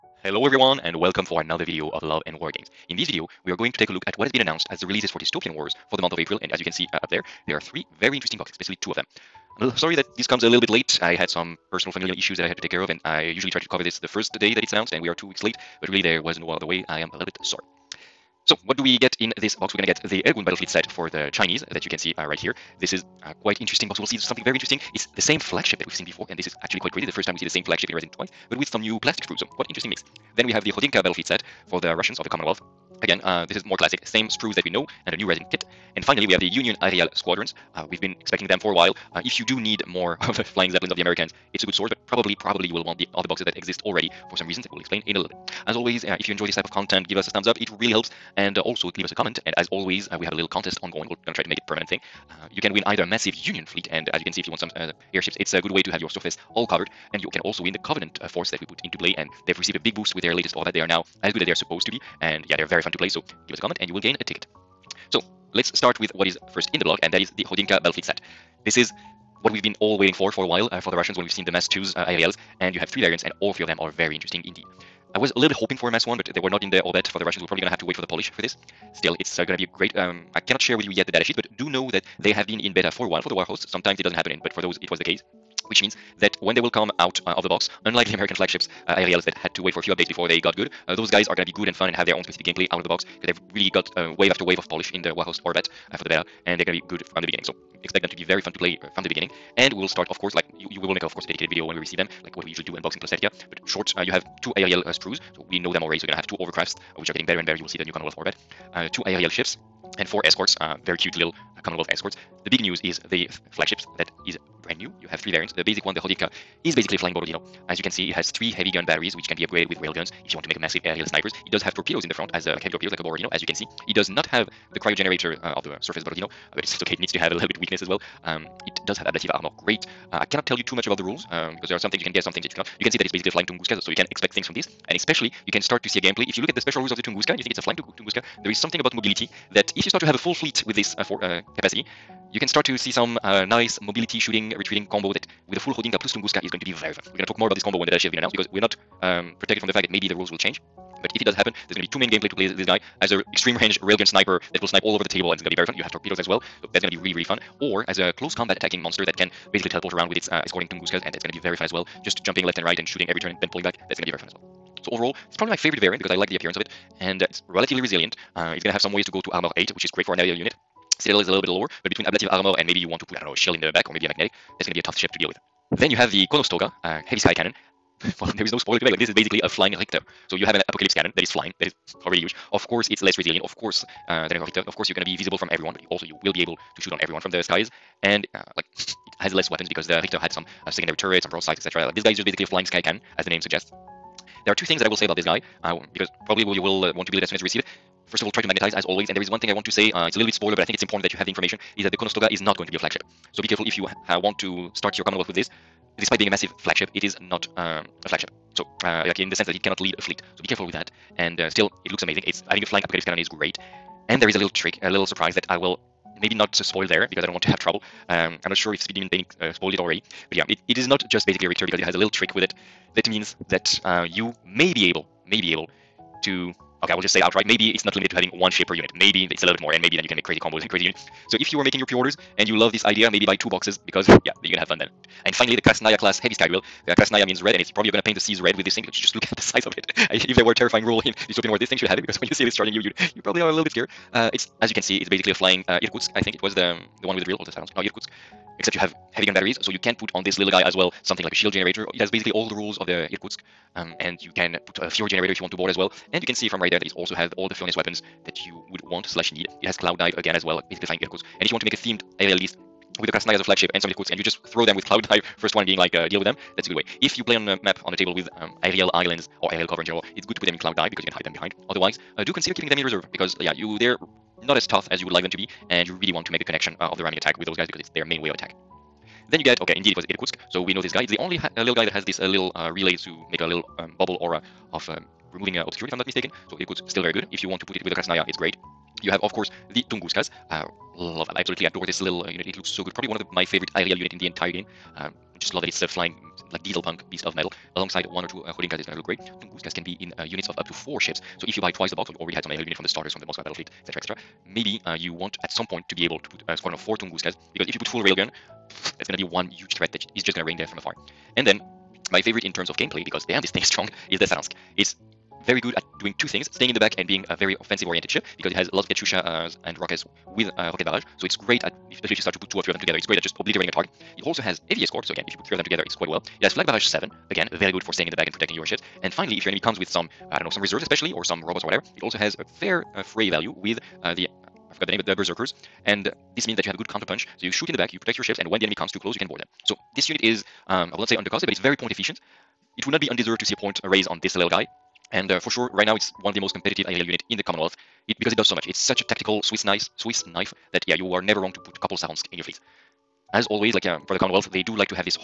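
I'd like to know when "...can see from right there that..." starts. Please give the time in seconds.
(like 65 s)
256 s.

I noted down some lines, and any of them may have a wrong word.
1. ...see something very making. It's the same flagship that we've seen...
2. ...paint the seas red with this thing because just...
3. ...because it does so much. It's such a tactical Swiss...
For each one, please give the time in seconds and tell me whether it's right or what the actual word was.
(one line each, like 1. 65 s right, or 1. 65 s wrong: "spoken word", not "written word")
1. 24 s wrong: "interesting", not "making"
2. 238 s right
3. 348 s right.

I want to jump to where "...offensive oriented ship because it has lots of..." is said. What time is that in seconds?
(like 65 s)
317 s.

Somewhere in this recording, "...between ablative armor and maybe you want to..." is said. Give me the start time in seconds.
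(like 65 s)
171 s.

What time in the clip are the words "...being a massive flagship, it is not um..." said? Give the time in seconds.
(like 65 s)
206 s.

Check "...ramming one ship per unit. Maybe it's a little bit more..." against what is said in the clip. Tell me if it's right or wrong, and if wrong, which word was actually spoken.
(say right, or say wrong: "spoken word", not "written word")
wrong: "having", not "ramming".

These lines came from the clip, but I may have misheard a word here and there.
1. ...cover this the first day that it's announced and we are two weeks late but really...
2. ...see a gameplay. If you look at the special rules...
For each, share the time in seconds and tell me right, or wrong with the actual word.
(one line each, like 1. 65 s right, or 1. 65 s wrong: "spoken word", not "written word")
1. 13 s right
2. 135 s right.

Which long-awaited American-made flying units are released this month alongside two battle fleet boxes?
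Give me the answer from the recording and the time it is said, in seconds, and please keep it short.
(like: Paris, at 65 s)
Union Aerial Squadrons, at 36 s.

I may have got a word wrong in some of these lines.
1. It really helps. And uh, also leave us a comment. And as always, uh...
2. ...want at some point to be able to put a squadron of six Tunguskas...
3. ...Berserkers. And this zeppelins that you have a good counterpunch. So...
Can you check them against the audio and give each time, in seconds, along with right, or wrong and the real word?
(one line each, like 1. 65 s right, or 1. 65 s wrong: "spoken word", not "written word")
1. 47 s right
2. 305 s wrong: "four", not "six"
3. 335 s wrong: "means", not "zeppelins".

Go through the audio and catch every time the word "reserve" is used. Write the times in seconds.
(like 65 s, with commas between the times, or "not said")
272 s, 330 s.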